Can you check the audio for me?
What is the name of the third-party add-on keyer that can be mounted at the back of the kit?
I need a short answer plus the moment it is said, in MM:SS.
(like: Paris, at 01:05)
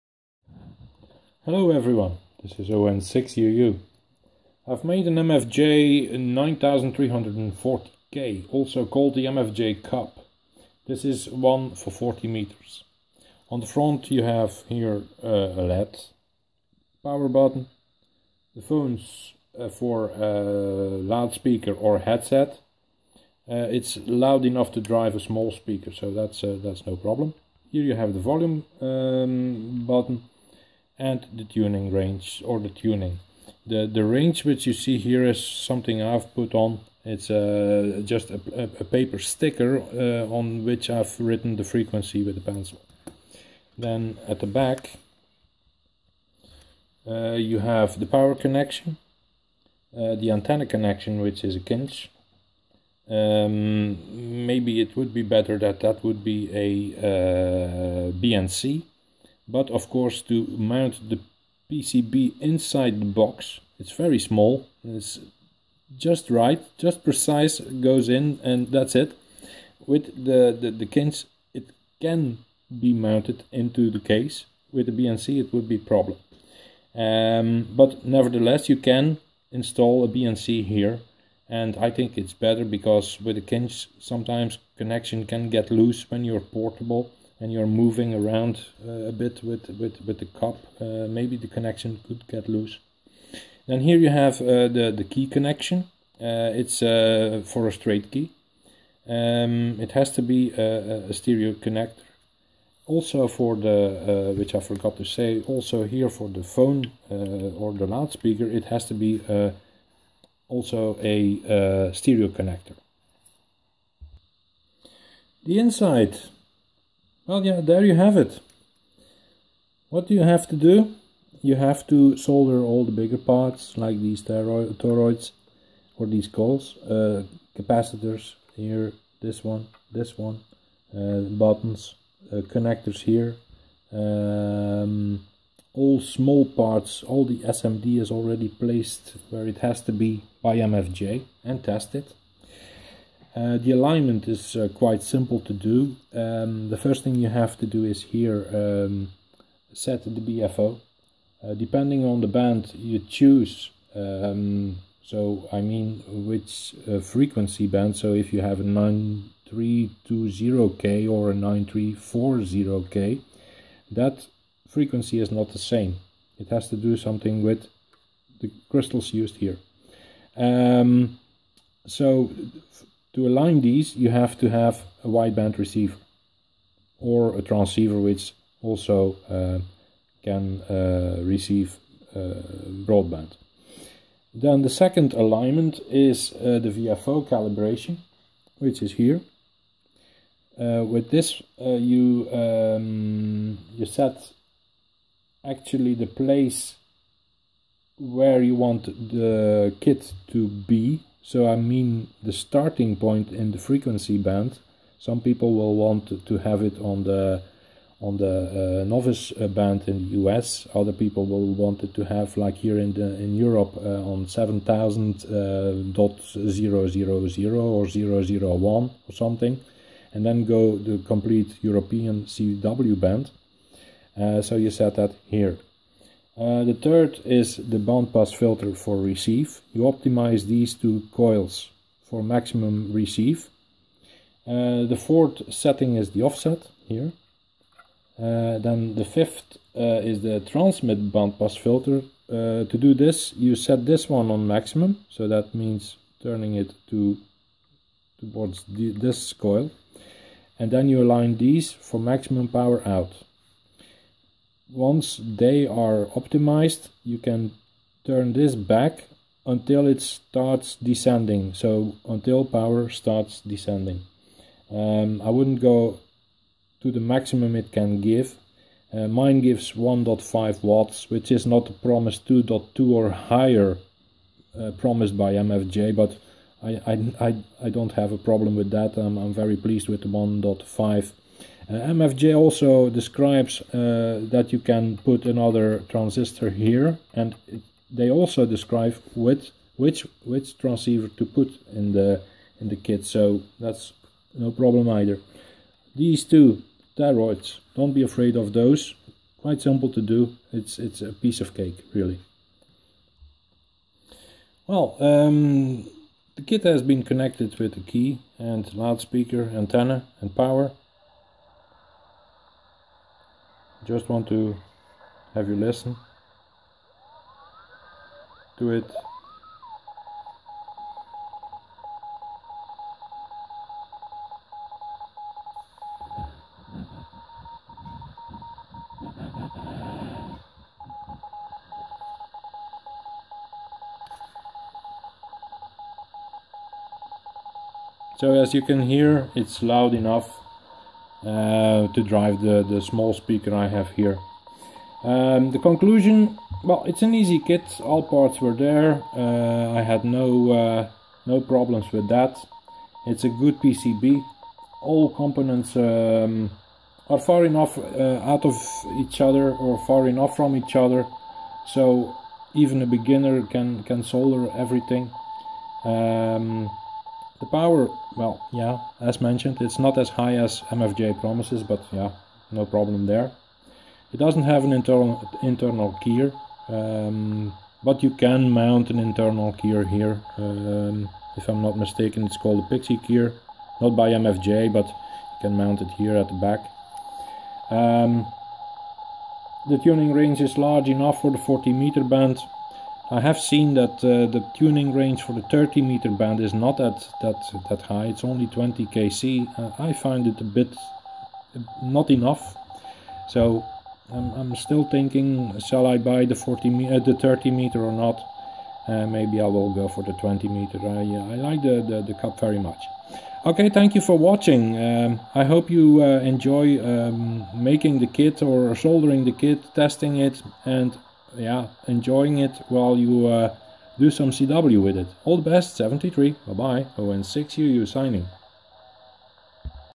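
Pixie keyer, at 06:22.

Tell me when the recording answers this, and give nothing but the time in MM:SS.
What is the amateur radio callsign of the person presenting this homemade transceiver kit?
00:02.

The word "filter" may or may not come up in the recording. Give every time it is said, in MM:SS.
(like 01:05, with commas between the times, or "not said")
03:48, 04:01.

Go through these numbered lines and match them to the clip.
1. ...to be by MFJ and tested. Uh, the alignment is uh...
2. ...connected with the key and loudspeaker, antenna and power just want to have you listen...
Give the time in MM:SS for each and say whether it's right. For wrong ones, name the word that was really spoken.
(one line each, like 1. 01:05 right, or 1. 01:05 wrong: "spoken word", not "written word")
1. 02:19 right
2. 05:07 right.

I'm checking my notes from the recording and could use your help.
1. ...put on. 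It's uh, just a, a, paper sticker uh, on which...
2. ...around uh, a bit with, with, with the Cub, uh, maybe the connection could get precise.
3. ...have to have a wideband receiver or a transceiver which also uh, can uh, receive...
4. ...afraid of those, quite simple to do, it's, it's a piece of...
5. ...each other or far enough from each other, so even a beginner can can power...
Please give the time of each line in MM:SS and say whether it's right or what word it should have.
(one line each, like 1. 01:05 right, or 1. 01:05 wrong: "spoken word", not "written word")
1. 00:36 right
2. 01:28 wrong: "loose", not "precise"
3. 02:54 right
4. 04:58 right
5. 05:58 wrong: "solder", not "power".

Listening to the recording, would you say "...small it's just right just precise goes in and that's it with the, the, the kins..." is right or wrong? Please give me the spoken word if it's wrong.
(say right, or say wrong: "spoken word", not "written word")
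right.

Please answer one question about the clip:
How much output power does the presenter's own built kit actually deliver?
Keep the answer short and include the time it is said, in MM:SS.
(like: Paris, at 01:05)
1.5 watts, at 04:29.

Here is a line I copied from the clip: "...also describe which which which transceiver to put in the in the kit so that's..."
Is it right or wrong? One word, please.
right.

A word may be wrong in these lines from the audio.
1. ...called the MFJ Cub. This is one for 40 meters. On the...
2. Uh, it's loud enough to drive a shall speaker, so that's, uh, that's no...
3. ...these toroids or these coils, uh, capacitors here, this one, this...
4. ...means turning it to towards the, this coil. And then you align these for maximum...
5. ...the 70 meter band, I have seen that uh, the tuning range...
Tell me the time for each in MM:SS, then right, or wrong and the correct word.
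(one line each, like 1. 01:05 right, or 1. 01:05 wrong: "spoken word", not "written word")
1. 00:08 right
2. 00:23 wrong: "small", not "shall"
3. 02:03 right
4. 04:05 right
5. 06:31 wrong: "40", not "70".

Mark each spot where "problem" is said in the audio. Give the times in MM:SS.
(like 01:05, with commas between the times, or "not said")
00:26, 01:15, 04:38, 04:54, 05:51, 06:12.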